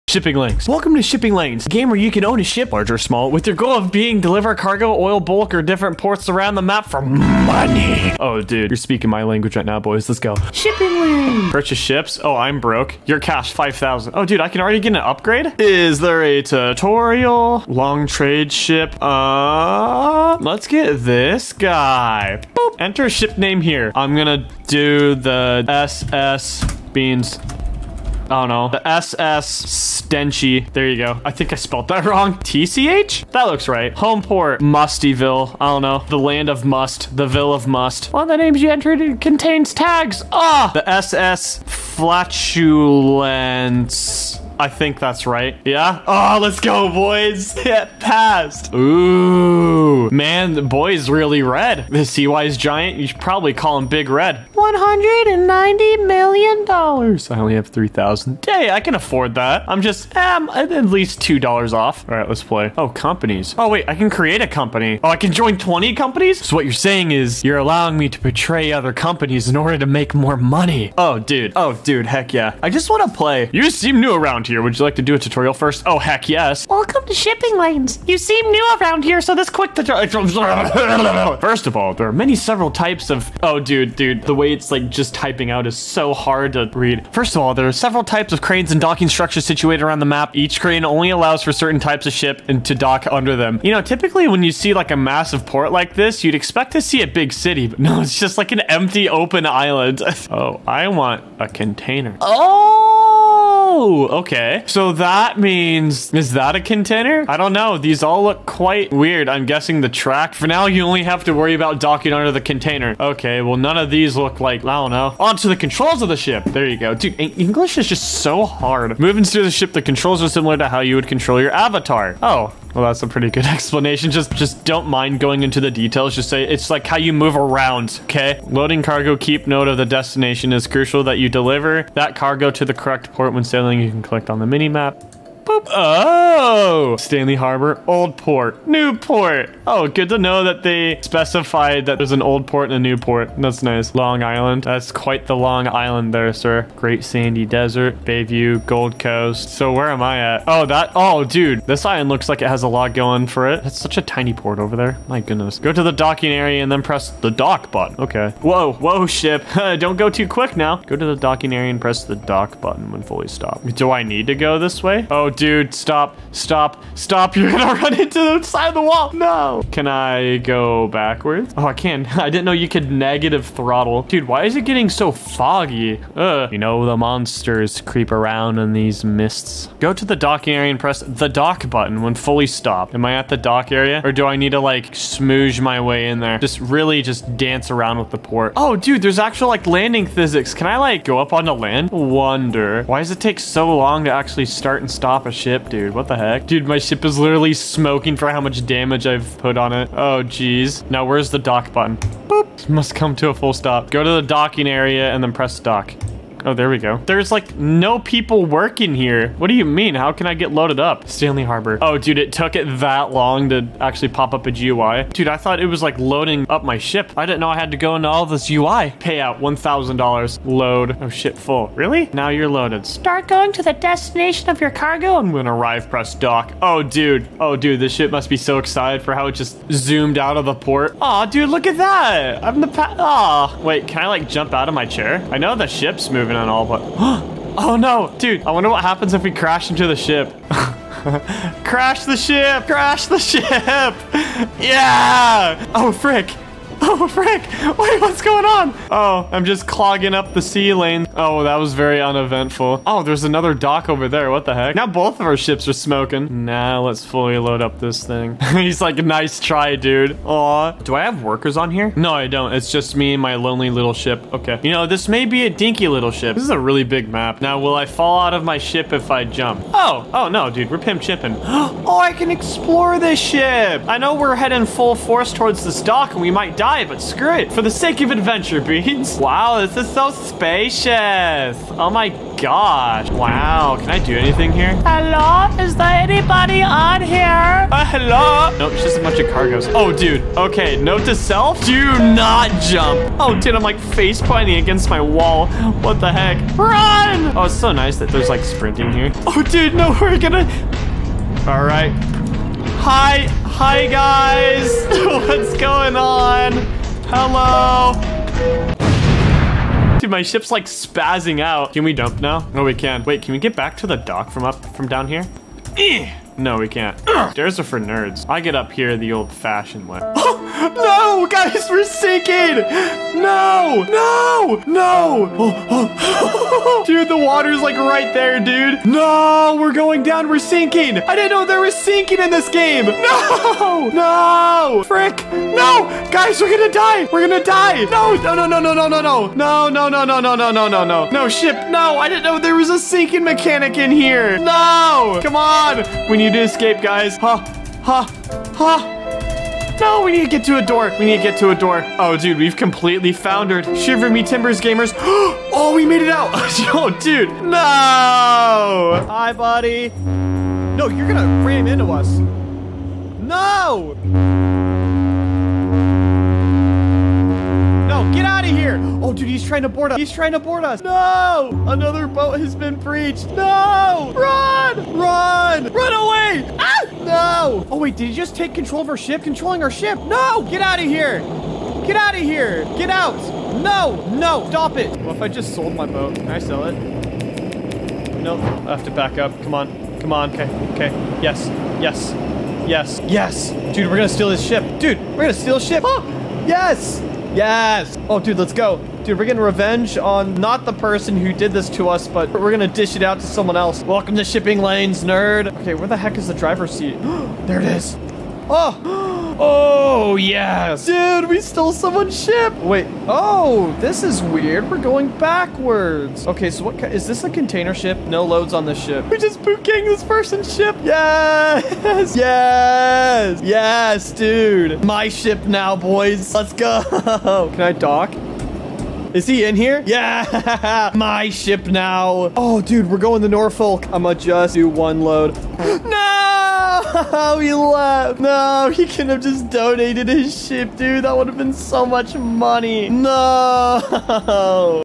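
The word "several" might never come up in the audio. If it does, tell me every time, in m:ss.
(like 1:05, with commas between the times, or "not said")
1:22, 1:27.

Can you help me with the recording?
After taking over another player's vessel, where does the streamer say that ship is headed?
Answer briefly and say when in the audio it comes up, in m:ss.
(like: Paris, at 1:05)
Norfolk, at 7:13.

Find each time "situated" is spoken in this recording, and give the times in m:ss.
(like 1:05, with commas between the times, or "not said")
1:29.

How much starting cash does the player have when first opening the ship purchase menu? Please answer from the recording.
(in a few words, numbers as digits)
5,000.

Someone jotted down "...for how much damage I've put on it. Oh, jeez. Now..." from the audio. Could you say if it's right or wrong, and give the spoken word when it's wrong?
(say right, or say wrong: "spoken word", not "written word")
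right.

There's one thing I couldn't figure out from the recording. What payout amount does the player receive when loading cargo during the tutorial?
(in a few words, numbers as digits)
$1,000.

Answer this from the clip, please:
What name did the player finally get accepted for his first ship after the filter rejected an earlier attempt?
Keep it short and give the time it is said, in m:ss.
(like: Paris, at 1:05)
SS Flatulence, at 0:40.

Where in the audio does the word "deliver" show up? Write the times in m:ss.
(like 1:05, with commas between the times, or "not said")
0:04, 2:11.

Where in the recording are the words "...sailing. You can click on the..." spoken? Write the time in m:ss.
2:13.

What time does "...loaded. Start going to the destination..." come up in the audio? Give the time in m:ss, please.
3:42.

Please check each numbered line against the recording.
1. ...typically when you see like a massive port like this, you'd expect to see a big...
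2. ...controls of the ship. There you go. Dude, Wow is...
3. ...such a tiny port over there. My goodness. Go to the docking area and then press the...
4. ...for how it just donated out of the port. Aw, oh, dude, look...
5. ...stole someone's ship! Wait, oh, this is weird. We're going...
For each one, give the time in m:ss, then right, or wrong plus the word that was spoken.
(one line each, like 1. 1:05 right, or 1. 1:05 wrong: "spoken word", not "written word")
1. 1:33 right
2. 1:55 wrong: "English", not "Wow"
3. 2:33 right
4. 3:49 wrong: "zoomed", not "donated"
5. 6:51 right.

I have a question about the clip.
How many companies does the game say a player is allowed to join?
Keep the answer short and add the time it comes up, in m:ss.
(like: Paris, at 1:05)
20, at 1:05.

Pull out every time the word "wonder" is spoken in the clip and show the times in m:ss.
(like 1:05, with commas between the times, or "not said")
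3:11, 3:58.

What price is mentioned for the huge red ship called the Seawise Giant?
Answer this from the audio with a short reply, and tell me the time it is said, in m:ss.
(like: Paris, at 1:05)
$190 million, at 0:54.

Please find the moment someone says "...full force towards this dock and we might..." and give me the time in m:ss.
4:34.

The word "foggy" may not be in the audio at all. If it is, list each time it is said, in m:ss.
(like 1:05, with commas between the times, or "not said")
2:55.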